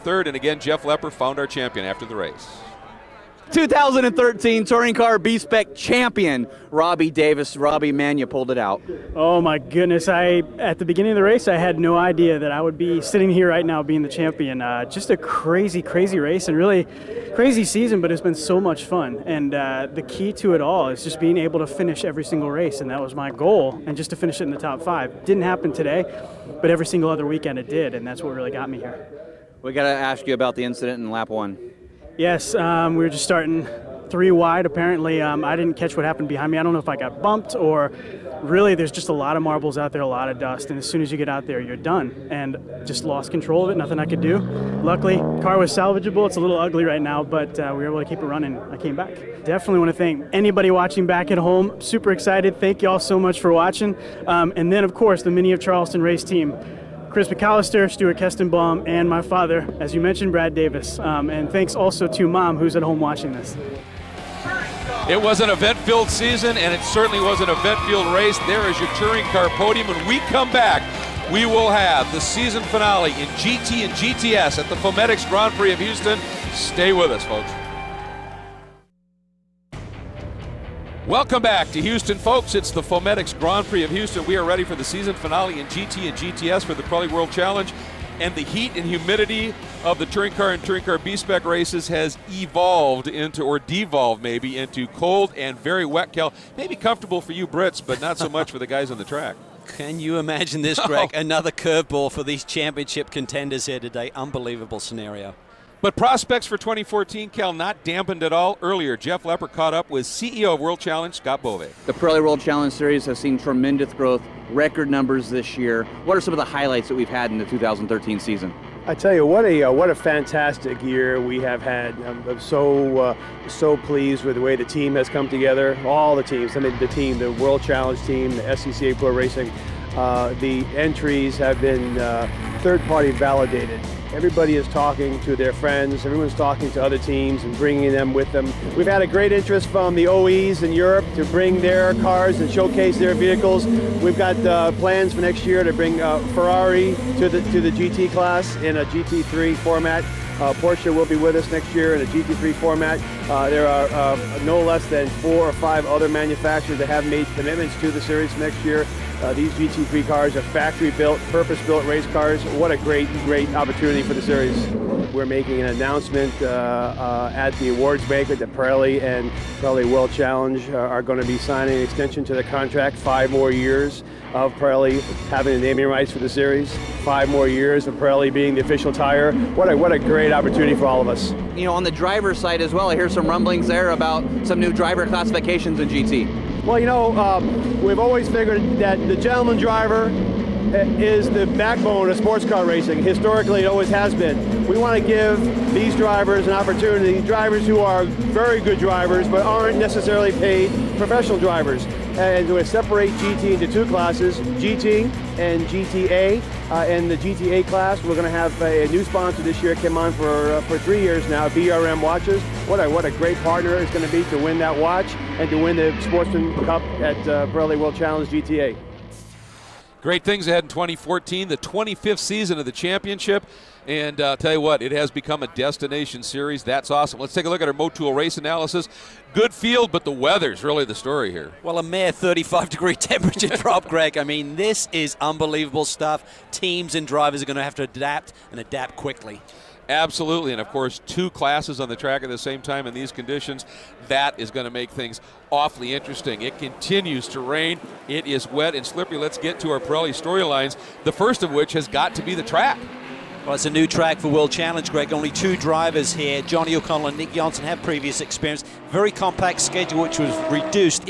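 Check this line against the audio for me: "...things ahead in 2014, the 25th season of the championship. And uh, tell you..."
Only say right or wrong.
right.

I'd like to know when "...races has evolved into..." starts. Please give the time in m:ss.
1:31.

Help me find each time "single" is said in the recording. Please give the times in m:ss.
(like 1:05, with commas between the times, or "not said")
0:22, 0:26.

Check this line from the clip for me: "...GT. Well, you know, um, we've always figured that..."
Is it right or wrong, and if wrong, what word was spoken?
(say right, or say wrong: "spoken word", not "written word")
right.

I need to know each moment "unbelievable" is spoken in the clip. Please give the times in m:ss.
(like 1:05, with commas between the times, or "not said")
1:44, 3:55.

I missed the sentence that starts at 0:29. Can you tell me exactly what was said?
We got to ask you about the incident in lap one.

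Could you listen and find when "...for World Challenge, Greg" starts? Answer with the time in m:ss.
4:14.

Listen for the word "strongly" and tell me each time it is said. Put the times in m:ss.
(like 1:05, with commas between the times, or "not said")
not said.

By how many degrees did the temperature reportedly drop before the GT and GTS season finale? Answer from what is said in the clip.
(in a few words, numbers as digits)
35.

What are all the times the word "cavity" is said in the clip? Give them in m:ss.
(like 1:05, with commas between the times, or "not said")
not said.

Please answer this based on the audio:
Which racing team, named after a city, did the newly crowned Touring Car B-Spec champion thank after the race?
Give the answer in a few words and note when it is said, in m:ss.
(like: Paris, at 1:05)
Mini of Charleston, at 0:55.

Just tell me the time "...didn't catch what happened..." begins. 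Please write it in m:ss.
0:35.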